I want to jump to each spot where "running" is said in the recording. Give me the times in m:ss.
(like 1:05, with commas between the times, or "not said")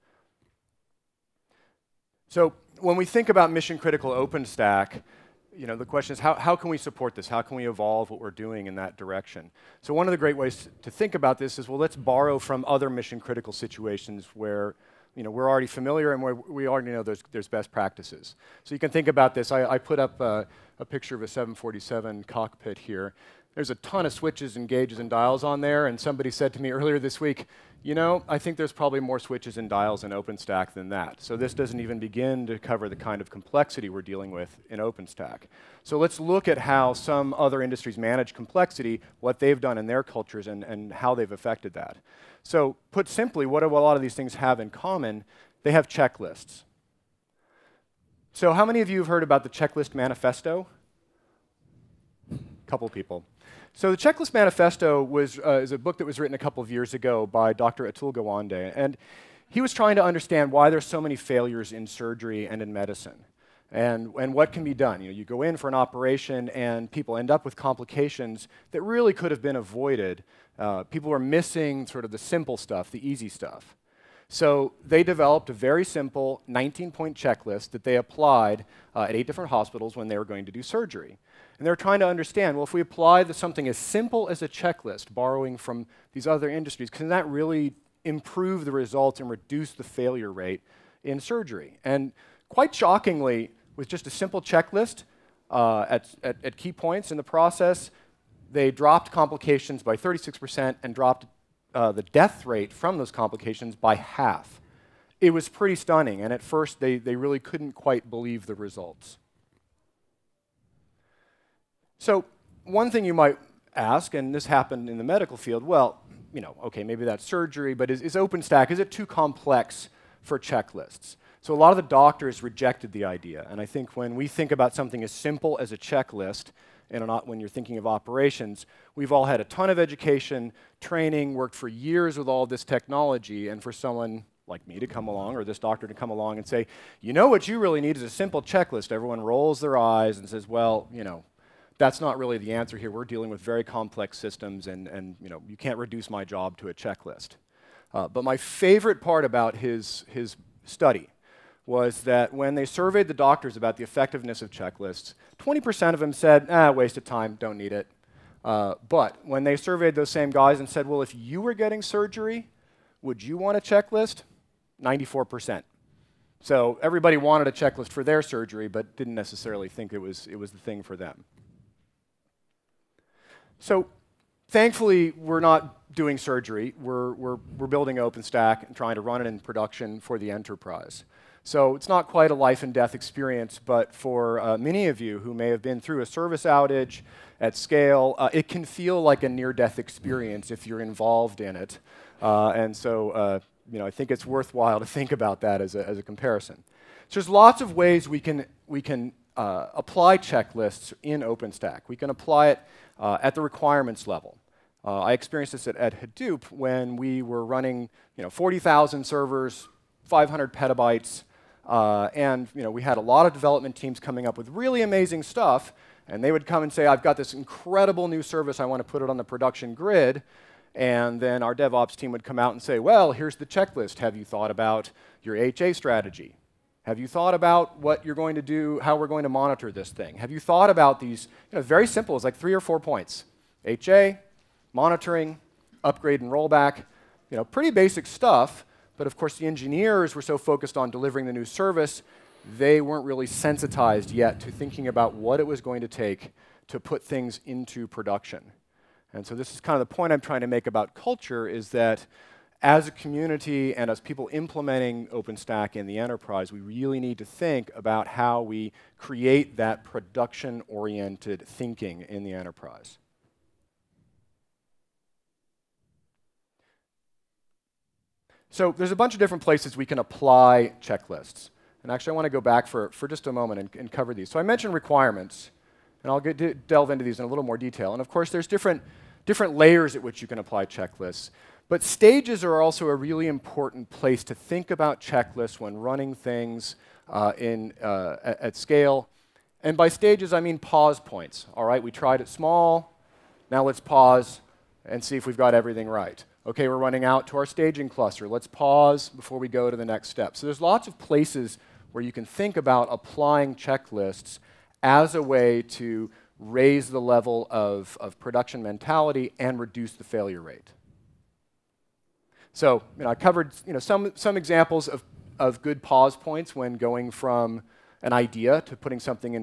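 3:27, 4:45, 4:56.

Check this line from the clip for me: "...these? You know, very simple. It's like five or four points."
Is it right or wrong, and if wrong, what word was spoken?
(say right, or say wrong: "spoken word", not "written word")
wrong: "three", not "five".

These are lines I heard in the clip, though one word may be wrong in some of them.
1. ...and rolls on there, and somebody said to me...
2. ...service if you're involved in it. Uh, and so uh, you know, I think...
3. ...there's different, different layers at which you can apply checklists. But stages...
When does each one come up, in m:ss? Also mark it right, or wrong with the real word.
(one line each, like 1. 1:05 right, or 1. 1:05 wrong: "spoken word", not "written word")
1. 0:24 wrong: "dials", not "rolls"
2. 3:09 wrong: "experience", not "service"
3. 4:38 right.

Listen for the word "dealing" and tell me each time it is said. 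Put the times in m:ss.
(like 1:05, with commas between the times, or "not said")
0:34, 2:23.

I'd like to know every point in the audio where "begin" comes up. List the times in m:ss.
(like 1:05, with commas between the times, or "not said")
0:31.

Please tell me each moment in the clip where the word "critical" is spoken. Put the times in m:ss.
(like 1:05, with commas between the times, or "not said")
0:03, 0:13.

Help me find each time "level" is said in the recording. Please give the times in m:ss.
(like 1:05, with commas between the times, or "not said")
3:24, 5:07.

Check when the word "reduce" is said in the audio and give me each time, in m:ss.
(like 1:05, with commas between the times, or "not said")
1:29, 2:25, 5:09.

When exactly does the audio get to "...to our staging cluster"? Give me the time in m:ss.
4:57.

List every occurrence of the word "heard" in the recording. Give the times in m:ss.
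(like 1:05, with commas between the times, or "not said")
0:49.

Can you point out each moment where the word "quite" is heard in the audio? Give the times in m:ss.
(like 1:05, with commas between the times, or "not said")
1:32, 1:47, 3:02.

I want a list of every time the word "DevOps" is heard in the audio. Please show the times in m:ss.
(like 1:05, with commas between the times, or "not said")
3:41.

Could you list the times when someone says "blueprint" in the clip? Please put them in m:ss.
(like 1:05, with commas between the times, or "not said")
not said.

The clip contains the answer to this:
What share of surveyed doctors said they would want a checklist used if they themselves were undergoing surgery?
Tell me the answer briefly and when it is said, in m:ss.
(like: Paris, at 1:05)
94%, at 2:44.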